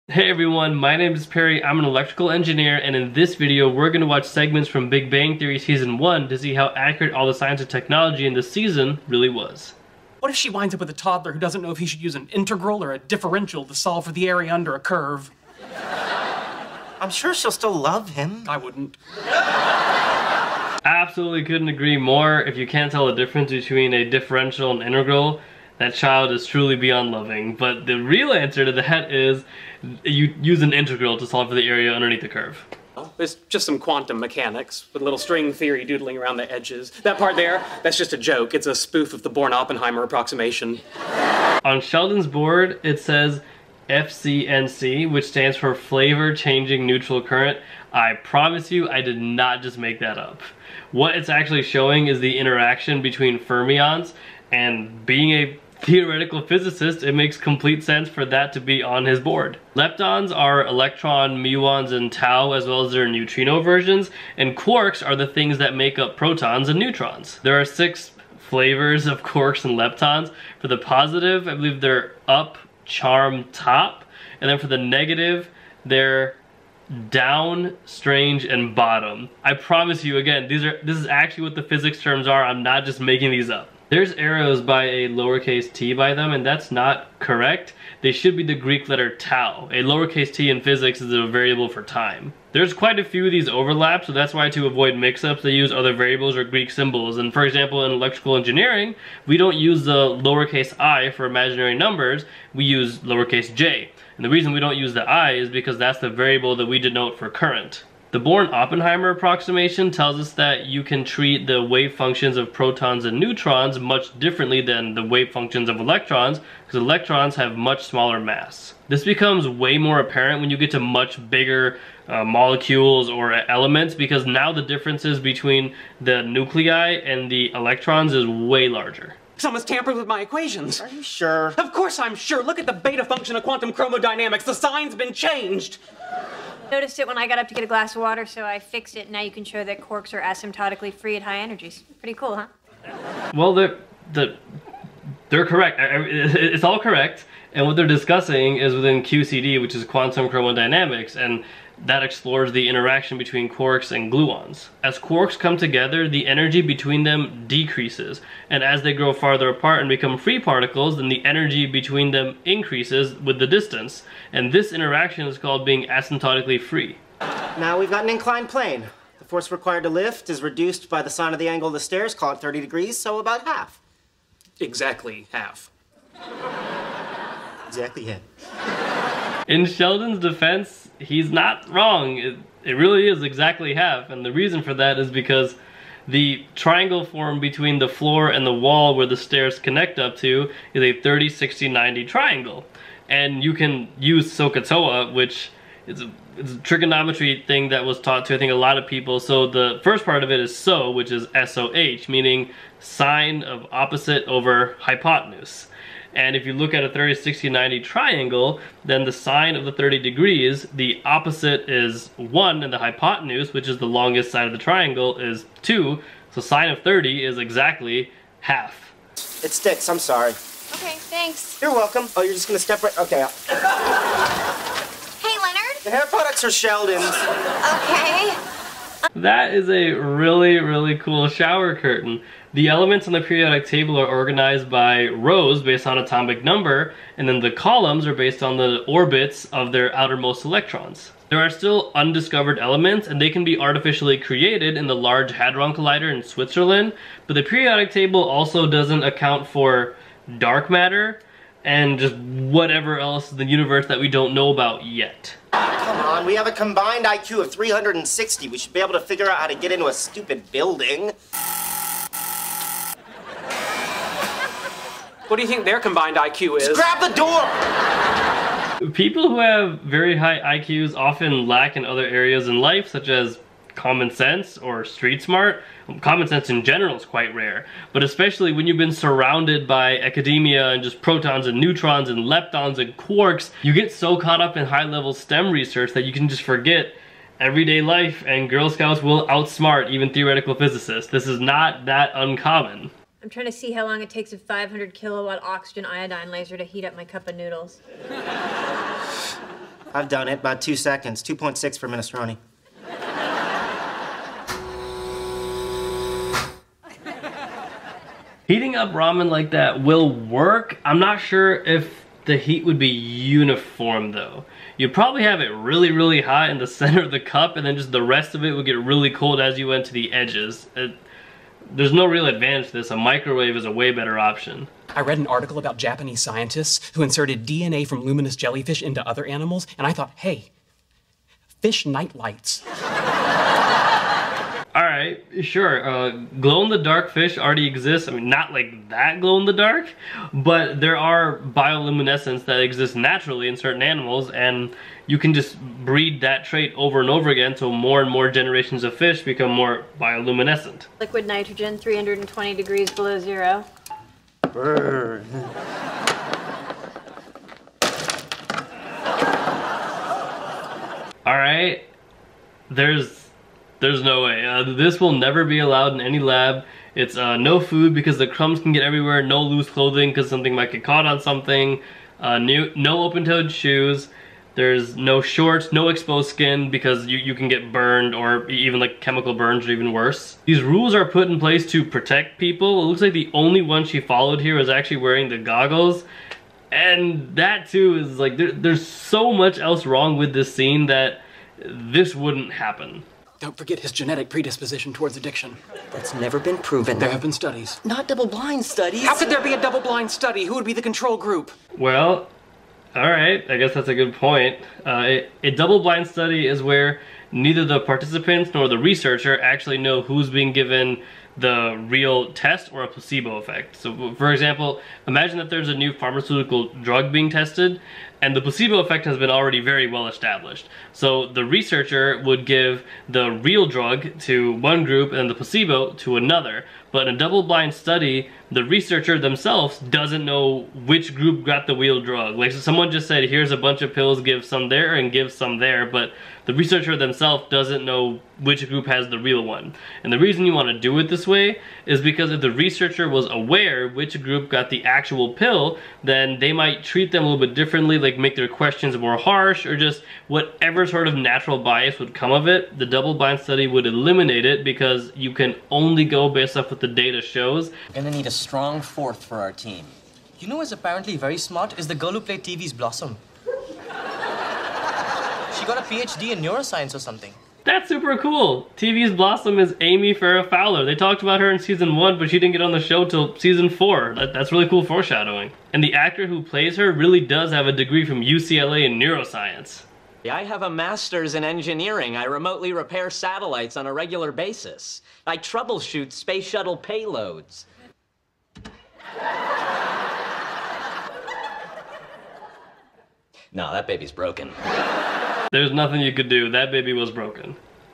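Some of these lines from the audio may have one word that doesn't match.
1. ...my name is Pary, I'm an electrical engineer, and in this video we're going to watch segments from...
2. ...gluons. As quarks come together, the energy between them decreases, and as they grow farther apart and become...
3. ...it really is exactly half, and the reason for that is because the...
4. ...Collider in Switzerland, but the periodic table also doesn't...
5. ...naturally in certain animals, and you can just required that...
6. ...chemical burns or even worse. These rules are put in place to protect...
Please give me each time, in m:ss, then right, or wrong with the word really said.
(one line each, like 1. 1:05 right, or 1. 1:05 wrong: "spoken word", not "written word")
1. 0:00 right
2. 2:34 right
3. 3:02 right
4. 4:05 right
5. 5:42 wrong: "breed", not "required"
6. 6:19 right.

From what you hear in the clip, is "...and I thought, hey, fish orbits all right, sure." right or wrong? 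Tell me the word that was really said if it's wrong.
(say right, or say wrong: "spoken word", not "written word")
wrong: "nightlights", not "orbits".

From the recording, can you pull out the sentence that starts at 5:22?
A microwave is a way better option.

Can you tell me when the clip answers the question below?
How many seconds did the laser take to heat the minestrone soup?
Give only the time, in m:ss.
5:01.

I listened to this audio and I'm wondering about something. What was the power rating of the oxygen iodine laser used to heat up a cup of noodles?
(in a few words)
500 kilowatts.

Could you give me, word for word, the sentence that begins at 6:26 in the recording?
And that too is like, there, there's so much else wrong with this scene that this wouldn't happen.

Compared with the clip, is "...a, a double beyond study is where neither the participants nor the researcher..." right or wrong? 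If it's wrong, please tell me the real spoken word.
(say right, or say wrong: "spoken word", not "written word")
wrong: "blind", not "beyond".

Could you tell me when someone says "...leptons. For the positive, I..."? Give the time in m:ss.
1:09.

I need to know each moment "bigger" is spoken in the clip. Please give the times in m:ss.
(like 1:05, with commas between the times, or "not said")
2:01.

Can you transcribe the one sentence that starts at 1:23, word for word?
There's arrows by a lowercase t by them, and that's not correct.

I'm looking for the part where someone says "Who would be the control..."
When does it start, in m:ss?
6:40.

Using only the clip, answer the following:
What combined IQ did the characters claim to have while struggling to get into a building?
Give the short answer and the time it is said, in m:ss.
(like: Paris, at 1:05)
360, at 4:17.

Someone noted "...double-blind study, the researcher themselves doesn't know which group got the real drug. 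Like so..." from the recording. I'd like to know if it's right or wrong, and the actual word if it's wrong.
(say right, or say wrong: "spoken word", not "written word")
right.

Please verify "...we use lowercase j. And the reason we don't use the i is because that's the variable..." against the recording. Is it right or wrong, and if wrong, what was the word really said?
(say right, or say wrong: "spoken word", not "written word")
right.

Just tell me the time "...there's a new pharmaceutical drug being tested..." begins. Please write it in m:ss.
6:55.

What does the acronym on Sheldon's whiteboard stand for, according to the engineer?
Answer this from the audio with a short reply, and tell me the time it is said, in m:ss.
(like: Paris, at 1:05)
Flavor Changing Neutral Current, at 0:45.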